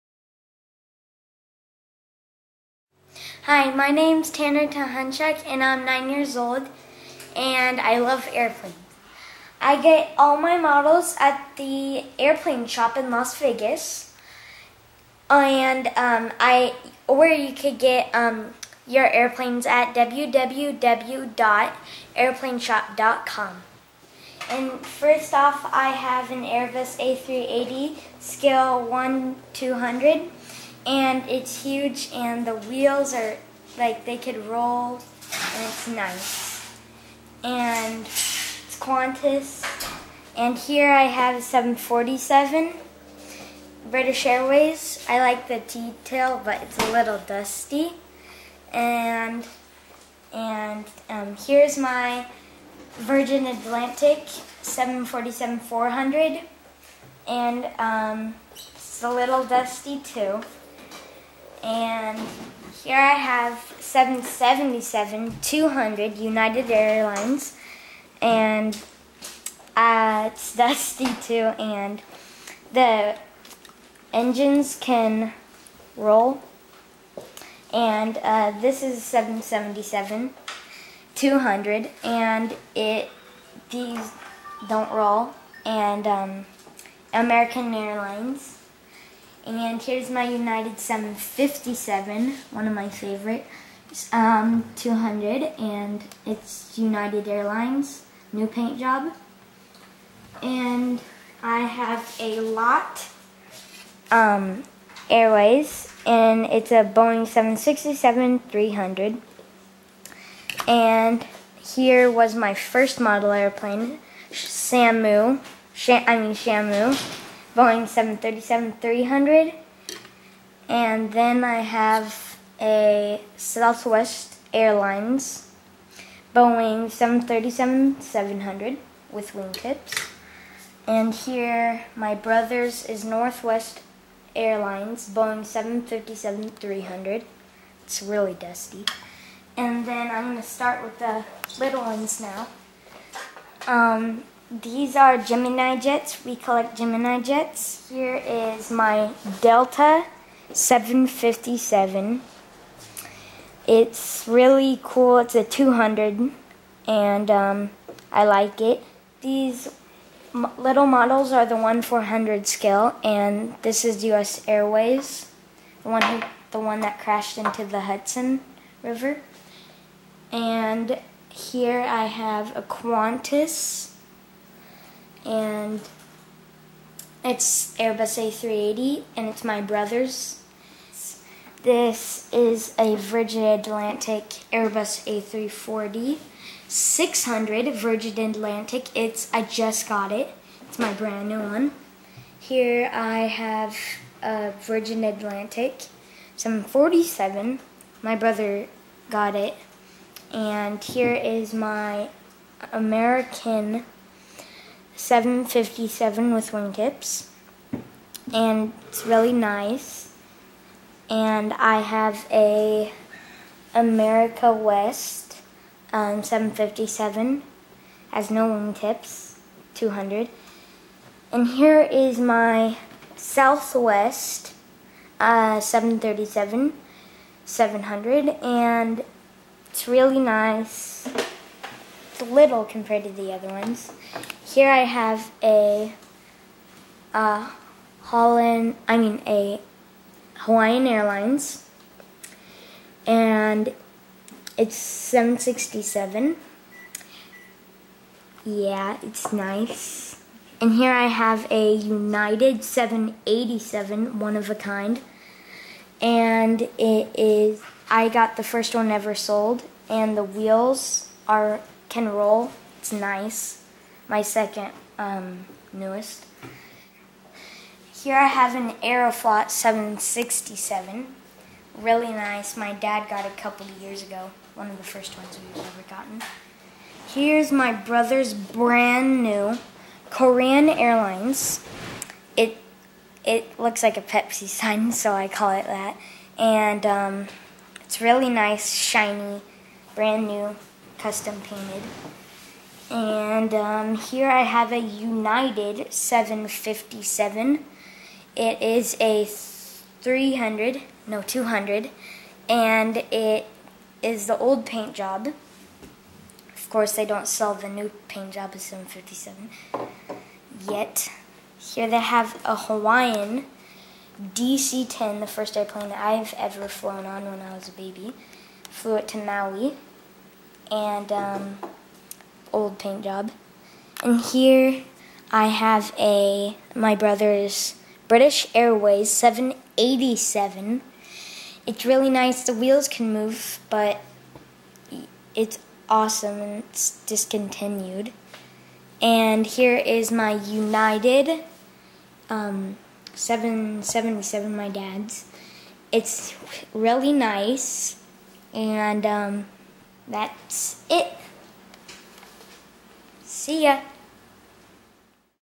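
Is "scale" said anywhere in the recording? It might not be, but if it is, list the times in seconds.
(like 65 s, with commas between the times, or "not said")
28 s, 162 s.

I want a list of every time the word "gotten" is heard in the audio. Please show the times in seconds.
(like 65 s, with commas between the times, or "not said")
275 s.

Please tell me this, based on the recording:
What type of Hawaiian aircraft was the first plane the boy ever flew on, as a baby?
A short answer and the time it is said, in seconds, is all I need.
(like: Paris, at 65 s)
DC-10, at 312 s.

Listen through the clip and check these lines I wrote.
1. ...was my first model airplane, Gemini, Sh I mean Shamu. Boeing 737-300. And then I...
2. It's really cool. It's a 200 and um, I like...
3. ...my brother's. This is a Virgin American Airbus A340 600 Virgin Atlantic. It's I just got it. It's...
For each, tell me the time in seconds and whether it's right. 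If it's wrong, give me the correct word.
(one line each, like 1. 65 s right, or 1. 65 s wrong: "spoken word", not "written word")
1. 112 s wrong: "Samu", not "Gemini"
2. 153 s right
3. 179 s wrong: "Atlantic", not "American".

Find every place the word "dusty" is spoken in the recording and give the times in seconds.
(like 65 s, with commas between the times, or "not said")
47 s, 59 s, 70 s, 138 s.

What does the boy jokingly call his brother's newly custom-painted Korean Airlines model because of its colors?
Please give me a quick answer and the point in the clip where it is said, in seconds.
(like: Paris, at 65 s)
Pepsi sign, at 284 s.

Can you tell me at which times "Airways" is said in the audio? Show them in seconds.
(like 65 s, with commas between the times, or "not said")
44 s, 105 s, 164 s, 328 s.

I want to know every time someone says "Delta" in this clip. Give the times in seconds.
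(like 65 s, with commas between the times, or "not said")
149 s.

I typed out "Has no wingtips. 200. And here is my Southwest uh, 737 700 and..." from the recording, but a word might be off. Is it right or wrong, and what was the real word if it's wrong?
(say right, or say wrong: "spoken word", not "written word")
right.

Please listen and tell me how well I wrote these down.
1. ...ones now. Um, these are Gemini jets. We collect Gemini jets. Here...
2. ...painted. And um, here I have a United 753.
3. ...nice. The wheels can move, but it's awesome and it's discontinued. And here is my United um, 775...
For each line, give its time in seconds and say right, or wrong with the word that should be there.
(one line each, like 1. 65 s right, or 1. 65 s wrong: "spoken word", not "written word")
1. 141 s right
2. 291 s wrong: "757", not "753"
3. 332 s wrong: "777", not "775".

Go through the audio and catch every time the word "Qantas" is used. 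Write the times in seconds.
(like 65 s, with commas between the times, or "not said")
38 s, 172 s.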